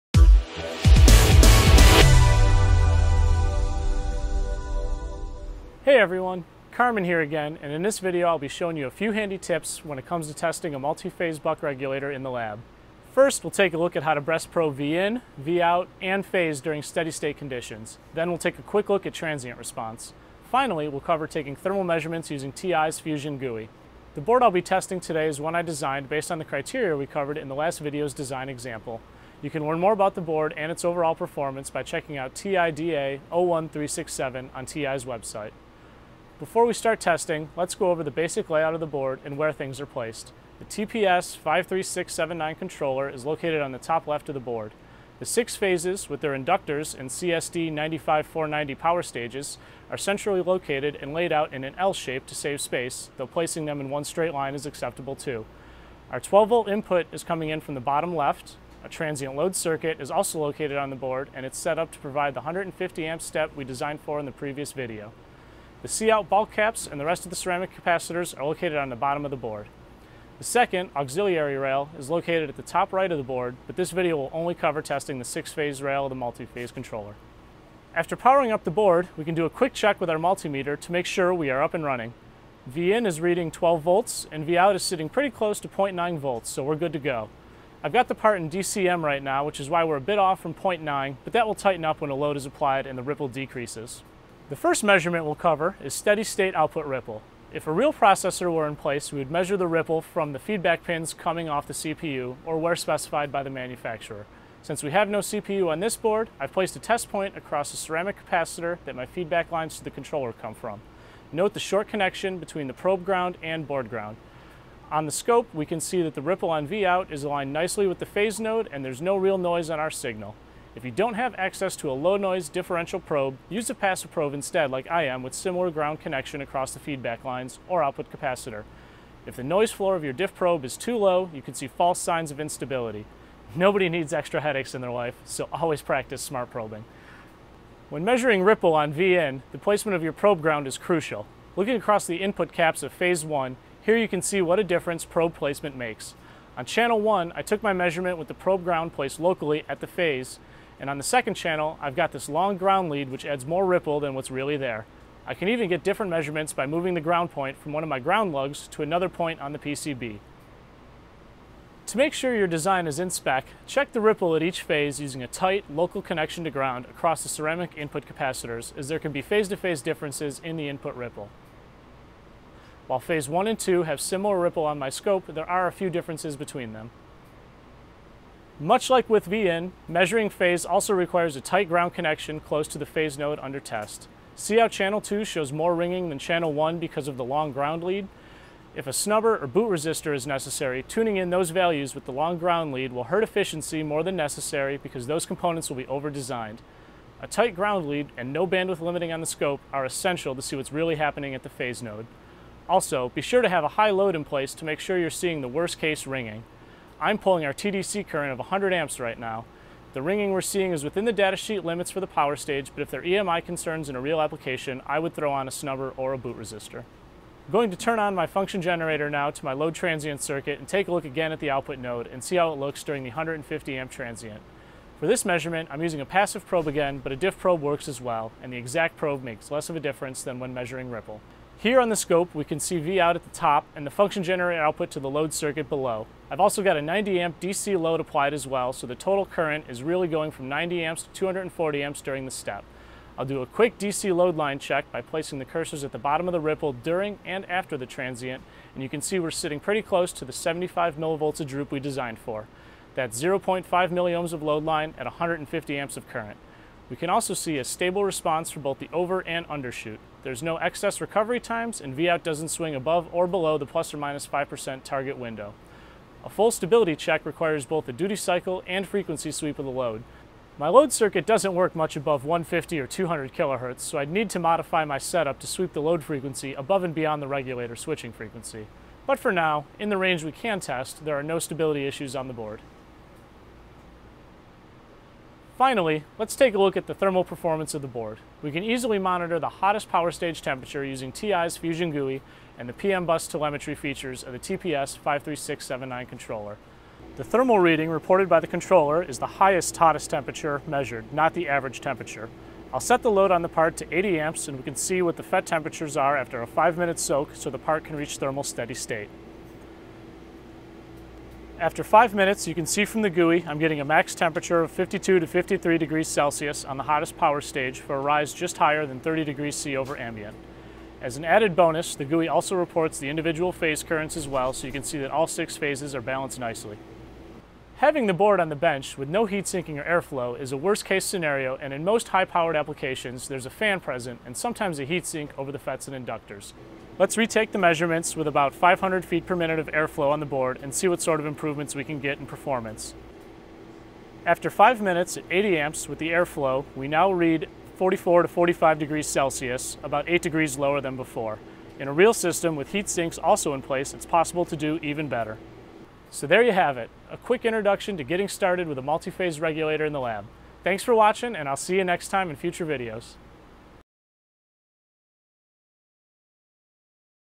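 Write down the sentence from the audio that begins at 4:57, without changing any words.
The thermal reading reported by the controller is the highest hottest temperature measured, not the average temperature.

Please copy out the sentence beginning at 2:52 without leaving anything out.
While phase 1 and 2 have similar ripple on my scope, there are a few differences between them.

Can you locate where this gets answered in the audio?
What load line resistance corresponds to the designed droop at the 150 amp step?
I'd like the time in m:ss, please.
4:13.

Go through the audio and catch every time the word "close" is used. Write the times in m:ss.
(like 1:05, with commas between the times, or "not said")
1:25, 3:02, 4:09.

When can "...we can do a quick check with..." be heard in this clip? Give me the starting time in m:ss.
1:19.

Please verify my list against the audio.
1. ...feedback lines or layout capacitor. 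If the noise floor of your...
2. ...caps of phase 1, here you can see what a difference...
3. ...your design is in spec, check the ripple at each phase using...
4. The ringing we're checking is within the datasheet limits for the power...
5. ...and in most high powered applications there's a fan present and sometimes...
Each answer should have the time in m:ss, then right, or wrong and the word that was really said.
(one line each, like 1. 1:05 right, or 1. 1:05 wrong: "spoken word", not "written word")
1. 2:06 wrong: "output", not "layout"
2. 2:22 right
3. 2:42 right
4. 3:29 wrong: "seeing", not "checking"
5. 5:31 right.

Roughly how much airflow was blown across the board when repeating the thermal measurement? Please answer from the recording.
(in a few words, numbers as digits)
500 feet per minute.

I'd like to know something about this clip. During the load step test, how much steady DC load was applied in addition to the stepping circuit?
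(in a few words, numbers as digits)
90 amps.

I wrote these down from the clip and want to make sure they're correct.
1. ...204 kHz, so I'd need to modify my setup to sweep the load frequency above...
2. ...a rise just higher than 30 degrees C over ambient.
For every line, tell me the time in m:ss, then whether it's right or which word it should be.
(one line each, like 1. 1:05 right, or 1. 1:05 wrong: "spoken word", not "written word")
1. 4:32 wrong: "200", not "204"
2. 5:17 right.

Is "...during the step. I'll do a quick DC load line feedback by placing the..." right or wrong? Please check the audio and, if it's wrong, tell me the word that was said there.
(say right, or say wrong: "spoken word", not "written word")
wrong: "check", not "feedback".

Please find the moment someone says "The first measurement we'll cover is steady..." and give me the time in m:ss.
1:34.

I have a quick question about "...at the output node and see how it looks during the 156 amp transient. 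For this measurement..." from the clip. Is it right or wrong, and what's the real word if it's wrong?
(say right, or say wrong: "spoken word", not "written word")
wrong: "150", not "156".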